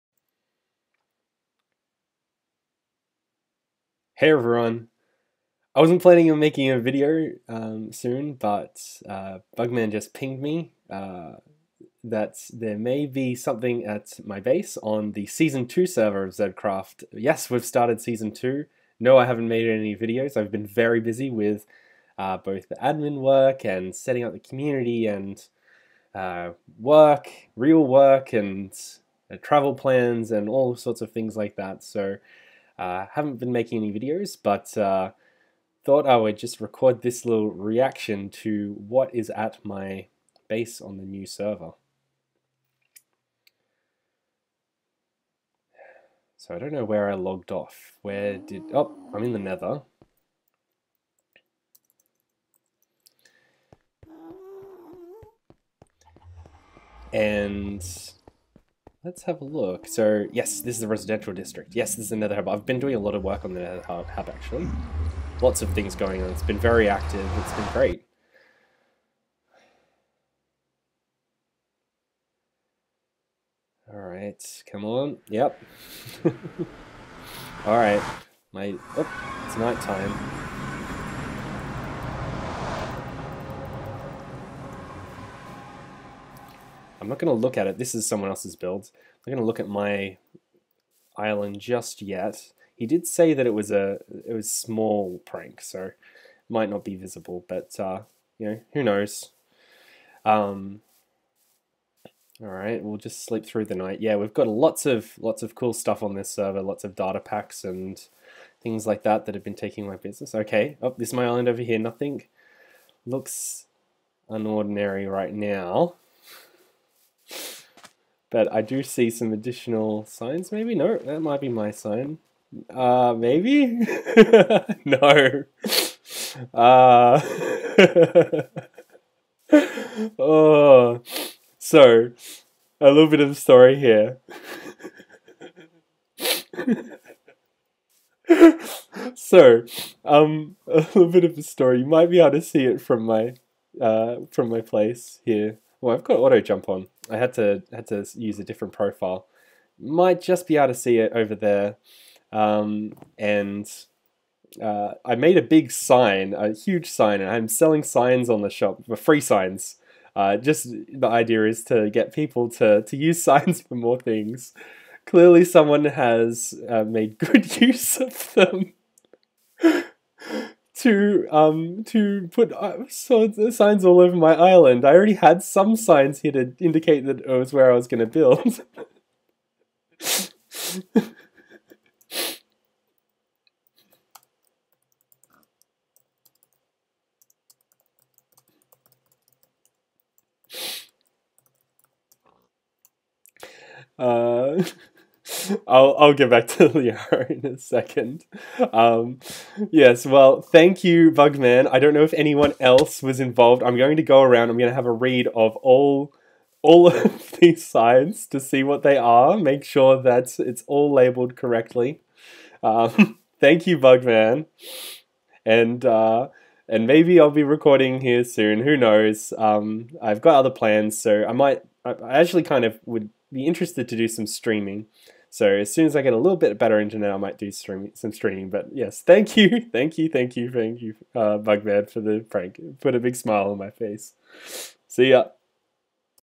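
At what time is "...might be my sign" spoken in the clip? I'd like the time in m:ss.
2:01.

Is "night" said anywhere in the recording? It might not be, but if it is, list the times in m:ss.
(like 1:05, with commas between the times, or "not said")
1:19, 1:43.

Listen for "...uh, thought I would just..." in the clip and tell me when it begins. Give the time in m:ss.
0:34.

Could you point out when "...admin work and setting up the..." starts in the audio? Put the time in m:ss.
0:22.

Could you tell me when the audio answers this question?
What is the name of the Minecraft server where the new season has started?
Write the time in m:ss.
0:16.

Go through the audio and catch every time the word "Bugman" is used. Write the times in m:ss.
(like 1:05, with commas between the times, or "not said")
0:09, 3:21, 3:33, 3:51.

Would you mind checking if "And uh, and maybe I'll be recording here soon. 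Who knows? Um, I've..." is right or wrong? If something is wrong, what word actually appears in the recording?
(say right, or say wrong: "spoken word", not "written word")
right.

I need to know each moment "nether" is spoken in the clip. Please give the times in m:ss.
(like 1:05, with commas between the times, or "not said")
0:49, 1:03.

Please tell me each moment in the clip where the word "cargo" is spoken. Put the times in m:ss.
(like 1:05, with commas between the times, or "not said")
not said.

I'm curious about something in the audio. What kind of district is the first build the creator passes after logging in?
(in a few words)
residential district.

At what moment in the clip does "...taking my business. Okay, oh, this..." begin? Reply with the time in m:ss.
1:49.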